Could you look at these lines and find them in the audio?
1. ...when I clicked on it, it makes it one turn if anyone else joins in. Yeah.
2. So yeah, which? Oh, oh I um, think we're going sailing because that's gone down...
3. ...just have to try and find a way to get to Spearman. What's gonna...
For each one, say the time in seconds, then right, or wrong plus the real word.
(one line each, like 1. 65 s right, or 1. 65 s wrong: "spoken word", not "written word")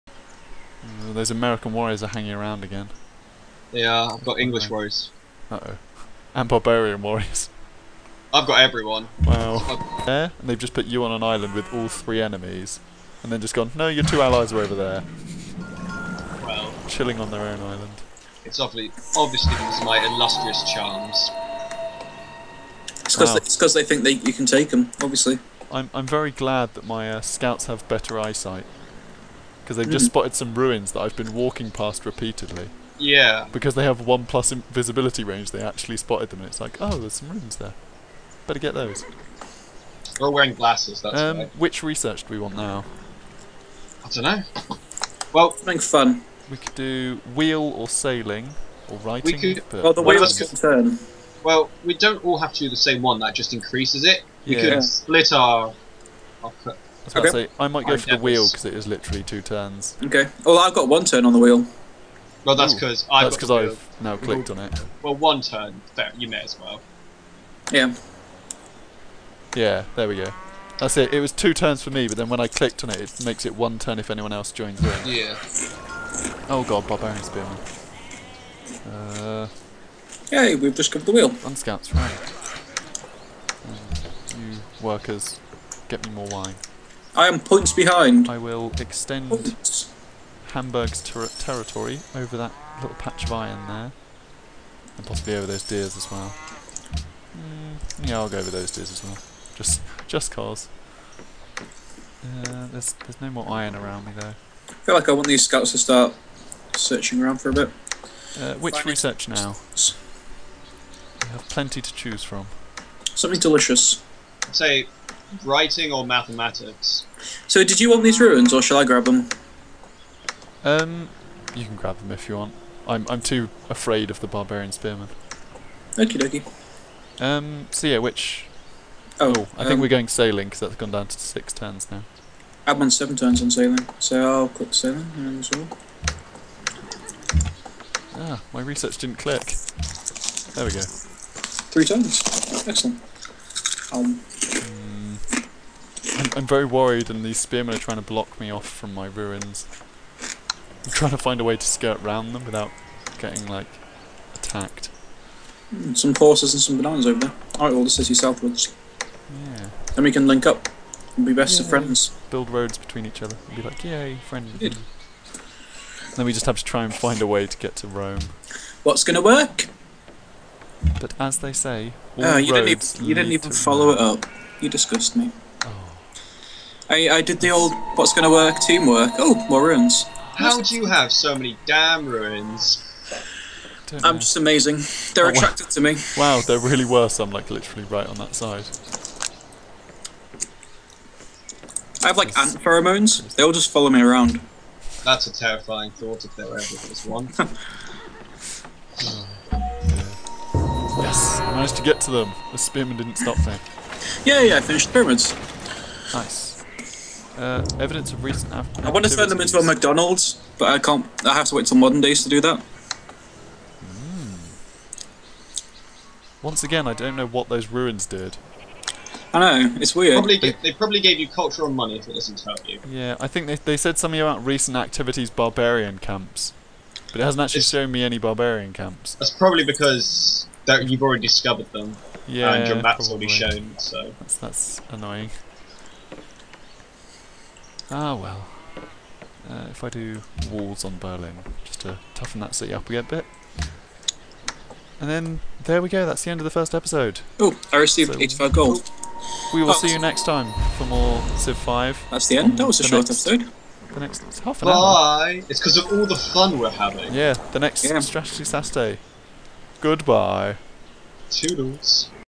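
1. 72 s right
2. 127 s right
3. 166 s wrong: "Rome", not "Spearman".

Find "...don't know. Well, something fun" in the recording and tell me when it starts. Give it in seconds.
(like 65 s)
44 s.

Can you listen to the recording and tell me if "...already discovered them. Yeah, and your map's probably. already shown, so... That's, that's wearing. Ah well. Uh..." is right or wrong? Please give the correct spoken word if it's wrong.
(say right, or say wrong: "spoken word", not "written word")
wrong: "annoying", not "wearing".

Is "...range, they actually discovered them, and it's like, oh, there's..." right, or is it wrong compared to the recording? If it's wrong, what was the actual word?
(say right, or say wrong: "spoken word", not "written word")
wrong: "spotted", not "discovered".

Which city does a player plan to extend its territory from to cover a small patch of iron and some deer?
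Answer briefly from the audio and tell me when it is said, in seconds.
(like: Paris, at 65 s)
Hamburg, at 90 s.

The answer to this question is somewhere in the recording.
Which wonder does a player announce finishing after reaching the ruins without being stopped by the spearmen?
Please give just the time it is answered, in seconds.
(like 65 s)
204 s.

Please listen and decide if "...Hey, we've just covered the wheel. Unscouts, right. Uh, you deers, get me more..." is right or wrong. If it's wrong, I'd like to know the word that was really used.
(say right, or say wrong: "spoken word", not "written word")
wrong: "workers", not "deers".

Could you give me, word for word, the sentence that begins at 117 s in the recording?
So, did you want these ruins, or shall I grab them?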